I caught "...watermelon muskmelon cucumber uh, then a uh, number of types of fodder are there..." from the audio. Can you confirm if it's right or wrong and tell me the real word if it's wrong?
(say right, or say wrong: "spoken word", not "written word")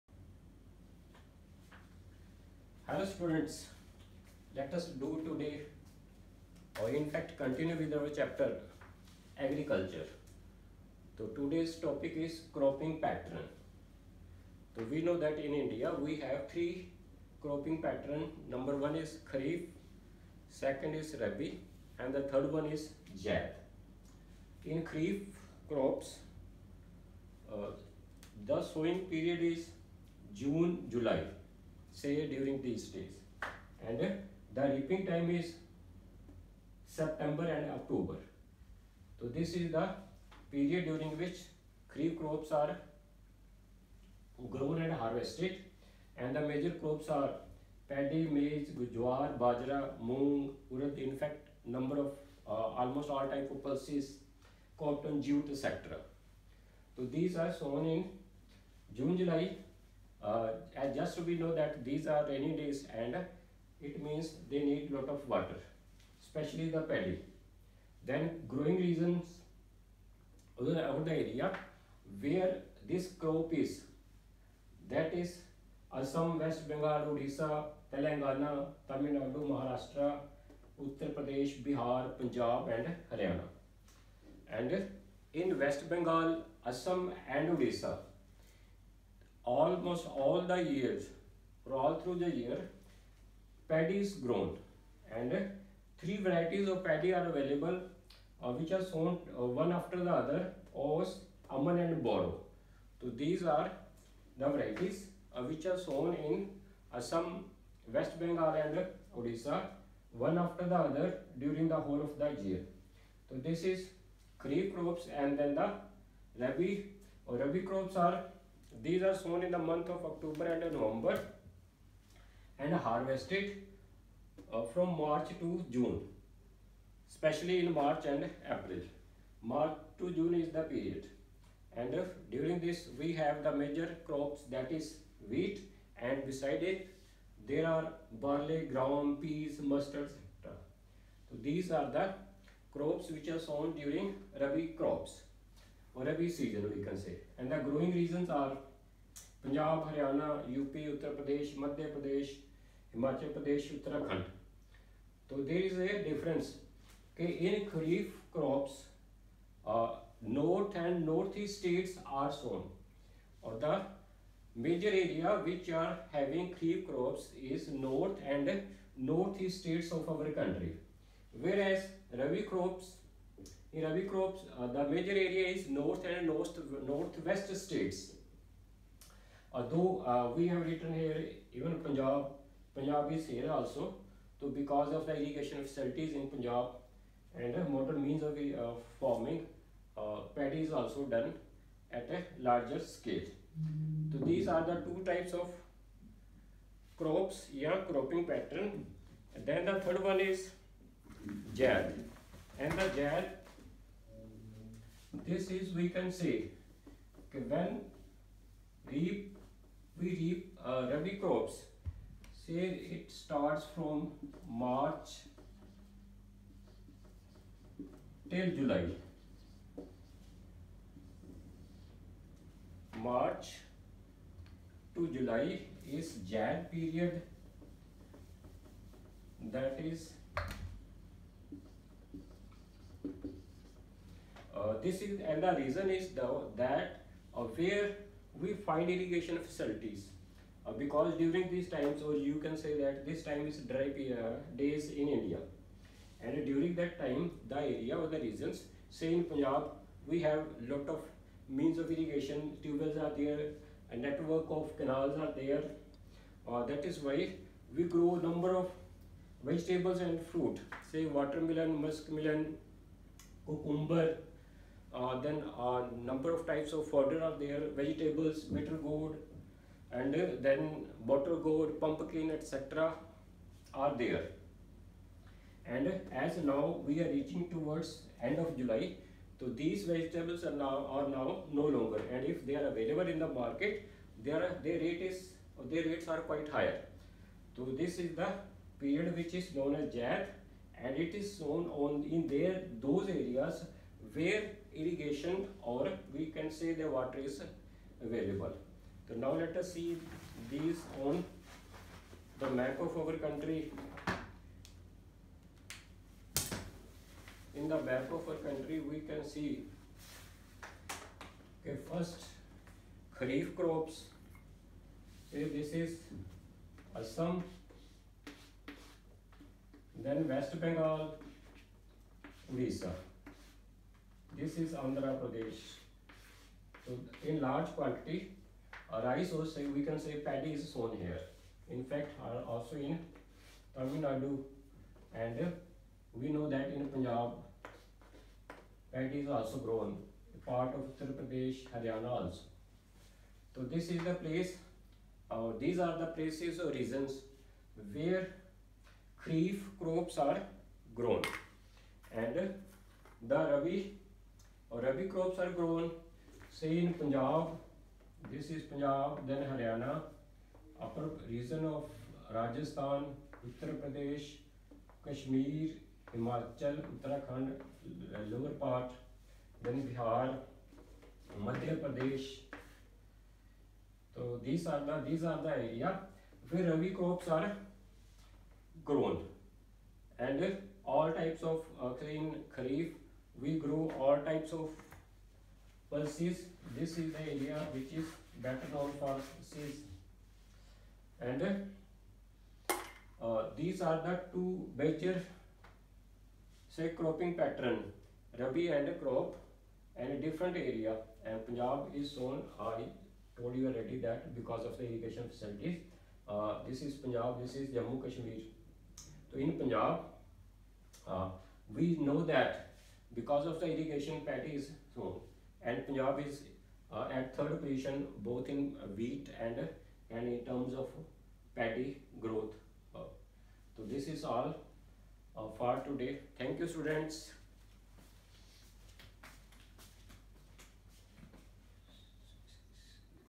right.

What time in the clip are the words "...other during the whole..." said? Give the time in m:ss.
1:50.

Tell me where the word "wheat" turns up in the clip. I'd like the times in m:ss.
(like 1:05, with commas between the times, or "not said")
2:15, 6:58.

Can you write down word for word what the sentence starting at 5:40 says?
Part of Uttar Pradesh, Haryana also.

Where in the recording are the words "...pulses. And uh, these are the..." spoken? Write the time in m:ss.
6:29.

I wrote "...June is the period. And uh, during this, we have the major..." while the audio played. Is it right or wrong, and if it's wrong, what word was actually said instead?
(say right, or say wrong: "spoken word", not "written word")
right.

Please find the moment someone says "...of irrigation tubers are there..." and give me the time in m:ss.
4:11.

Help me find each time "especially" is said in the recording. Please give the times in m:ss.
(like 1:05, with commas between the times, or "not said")
1:06, 2:07.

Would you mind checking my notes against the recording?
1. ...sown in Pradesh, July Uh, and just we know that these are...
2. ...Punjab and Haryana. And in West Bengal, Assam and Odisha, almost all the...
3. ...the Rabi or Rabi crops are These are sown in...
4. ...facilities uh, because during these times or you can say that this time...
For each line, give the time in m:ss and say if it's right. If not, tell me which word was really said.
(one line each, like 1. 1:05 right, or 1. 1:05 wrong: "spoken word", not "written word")
1. 0:57 wrong: "June", not "Pradesh"
2. 1:22 right
3. 1:55 right
4. 3:59 right.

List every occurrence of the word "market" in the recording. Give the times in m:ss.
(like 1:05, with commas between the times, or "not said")
4:43.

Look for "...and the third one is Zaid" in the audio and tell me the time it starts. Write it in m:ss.
0:21.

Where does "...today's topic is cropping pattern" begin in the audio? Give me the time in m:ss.
0:11.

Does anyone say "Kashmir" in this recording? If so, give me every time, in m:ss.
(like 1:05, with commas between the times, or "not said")
6:48.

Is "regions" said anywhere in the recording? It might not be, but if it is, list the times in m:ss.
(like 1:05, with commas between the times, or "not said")
1:08, 2:27, 4:08, 5:46.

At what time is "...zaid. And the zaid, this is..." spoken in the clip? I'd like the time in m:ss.
3:21.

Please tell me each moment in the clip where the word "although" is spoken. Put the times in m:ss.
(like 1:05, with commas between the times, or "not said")
2:59.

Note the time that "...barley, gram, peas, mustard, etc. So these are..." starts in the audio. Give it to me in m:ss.
2:18.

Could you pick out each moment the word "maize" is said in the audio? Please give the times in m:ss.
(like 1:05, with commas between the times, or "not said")
0:48.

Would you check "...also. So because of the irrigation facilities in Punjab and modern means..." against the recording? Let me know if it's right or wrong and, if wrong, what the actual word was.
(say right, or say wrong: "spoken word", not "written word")
right.